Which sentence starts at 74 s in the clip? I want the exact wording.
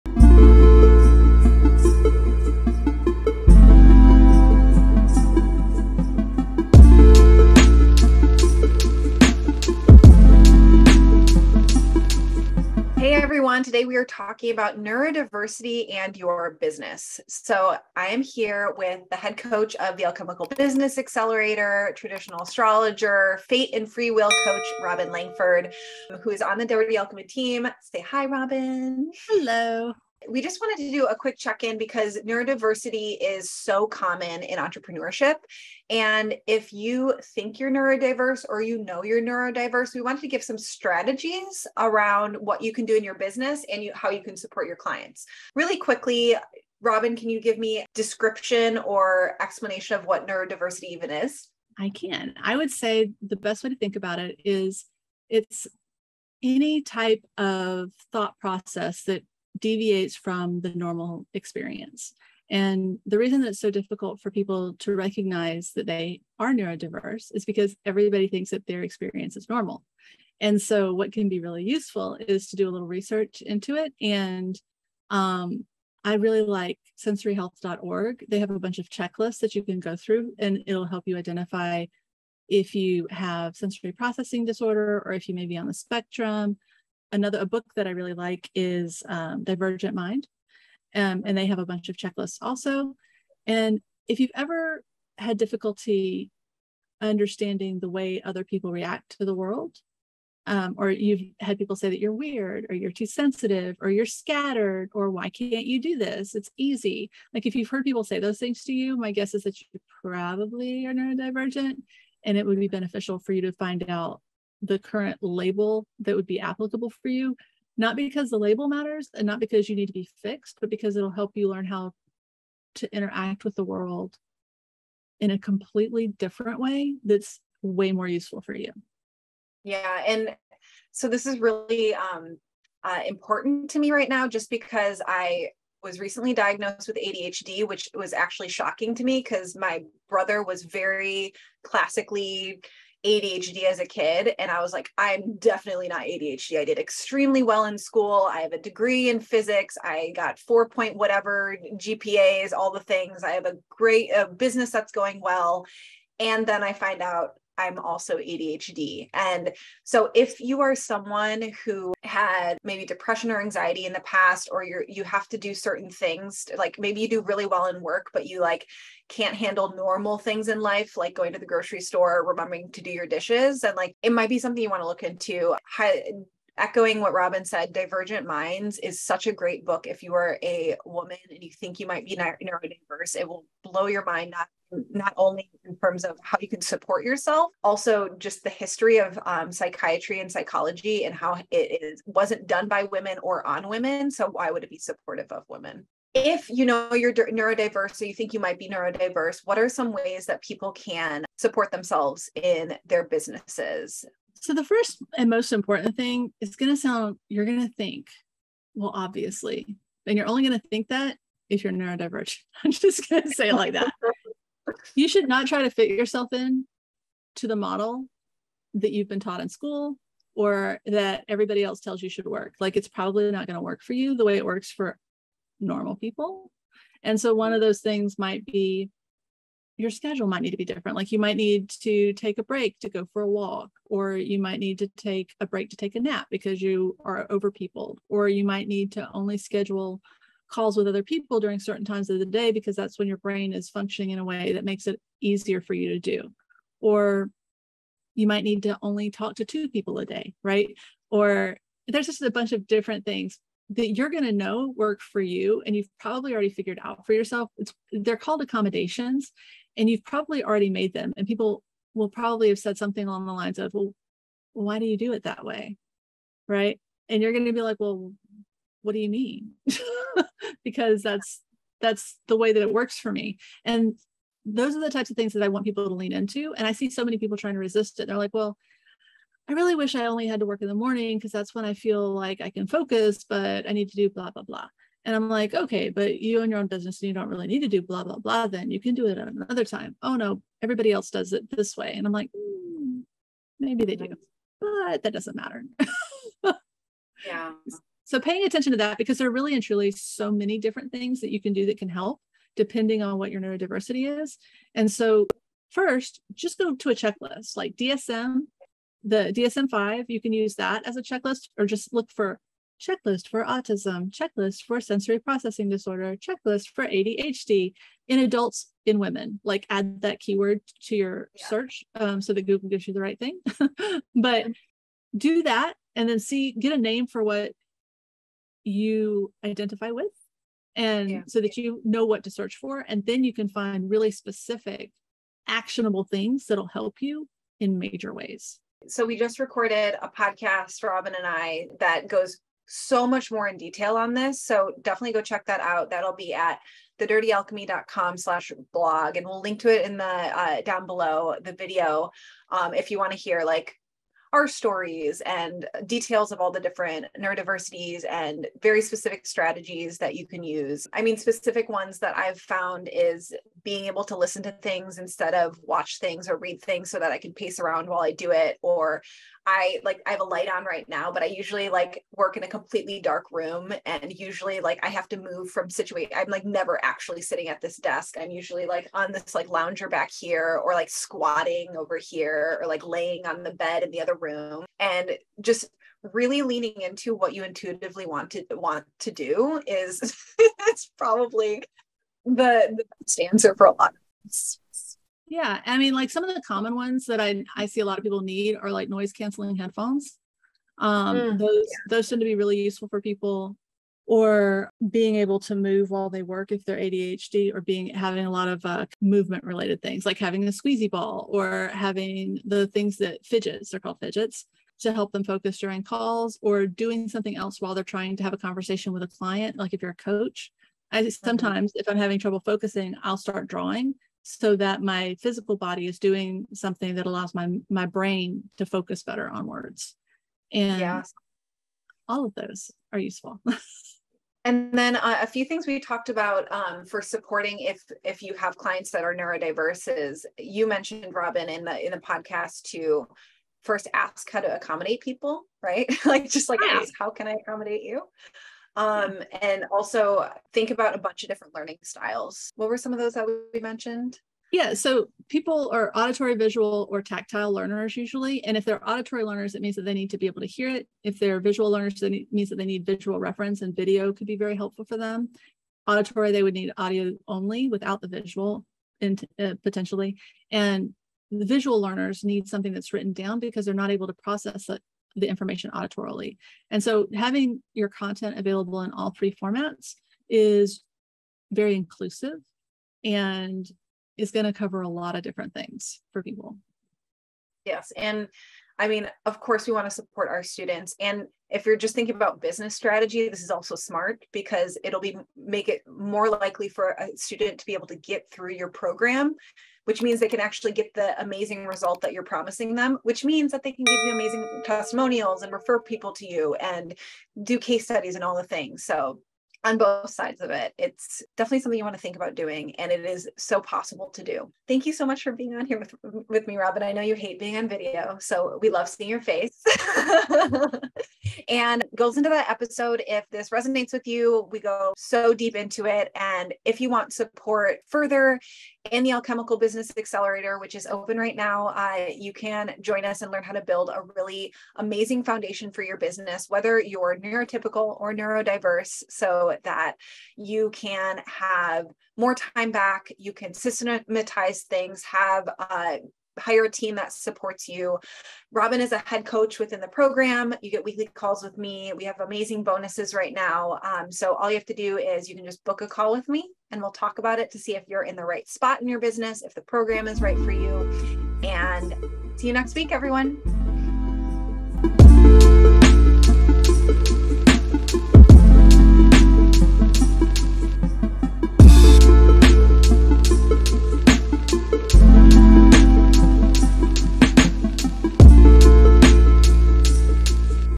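And um, I really like sensoryhealth.org.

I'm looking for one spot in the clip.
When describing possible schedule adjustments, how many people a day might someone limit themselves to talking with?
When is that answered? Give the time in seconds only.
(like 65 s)
249 s.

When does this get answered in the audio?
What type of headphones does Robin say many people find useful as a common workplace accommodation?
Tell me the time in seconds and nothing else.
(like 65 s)
398 s.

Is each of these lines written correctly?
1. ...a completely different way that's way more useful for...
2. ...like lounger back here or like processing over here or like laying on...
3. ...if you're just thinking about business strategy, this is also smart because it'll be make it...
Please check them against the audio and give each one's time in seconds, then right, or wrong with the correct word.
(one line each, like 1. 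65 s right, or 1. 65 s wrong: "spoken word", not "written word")
1. 125 s right
2. 379 s wrong: "squatting", not "processing"
3. 491 s right.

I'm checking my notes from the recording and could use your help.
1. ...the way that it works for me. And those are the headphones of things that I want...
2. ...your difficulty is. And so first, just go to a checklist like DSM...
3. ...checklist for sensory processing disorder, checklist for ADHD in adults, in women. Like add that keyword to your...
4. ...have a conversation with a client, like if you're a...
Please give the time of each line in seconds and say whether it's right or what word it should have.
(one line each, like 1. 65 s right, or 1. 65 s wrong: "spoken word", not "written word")
1. 272 s wrong: "types", not "headphones"
2. 303 s wrong: "neurodiversity", not "difficulty"
3. 314 s right
4. 418 s right.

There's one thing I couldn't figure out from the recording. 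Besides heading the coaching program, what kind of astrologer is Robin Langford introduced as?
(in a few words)
traditional astrologer.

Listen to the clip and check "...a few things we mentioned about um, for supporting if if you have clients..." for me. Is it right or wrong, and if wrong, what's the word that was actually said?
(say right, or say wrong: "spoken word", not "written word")
wrong: "talked", not "mentioned".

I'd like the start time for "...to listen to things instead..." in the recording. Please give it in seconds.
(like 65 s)
364 s.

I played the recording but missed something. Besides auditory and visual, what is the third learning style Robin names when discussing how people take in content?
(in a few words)
tactile.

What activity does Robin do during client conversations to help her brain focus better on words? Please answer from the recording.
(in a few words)
drawing.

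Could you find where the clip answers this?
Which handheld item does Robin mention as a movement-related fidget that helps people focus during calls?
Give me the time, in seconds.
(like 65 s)
410 s.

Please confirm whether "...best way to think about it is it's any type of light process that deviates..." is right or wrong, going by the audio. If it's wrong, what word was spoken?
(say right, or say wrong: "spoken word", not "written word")
wrong: "thought", not "light".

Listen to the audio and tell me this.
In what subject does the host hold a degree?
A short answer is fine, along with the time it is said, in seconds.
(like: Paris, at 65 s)
physics, at 149 s.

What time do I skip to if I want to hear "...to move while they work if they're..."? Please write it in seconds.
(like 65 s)
405 s.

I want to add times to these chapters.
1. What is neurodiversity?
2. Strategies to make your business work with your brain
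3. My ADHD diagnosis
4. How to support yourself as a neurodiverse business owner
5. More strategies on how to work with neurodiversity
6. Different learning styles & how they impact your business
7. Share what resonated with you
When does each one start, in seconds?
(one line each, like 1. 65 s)
1. 45 s
2. 70 s
3. 129 s
4. 196 s
5. 339 s
6. 450 s
7. 521 s.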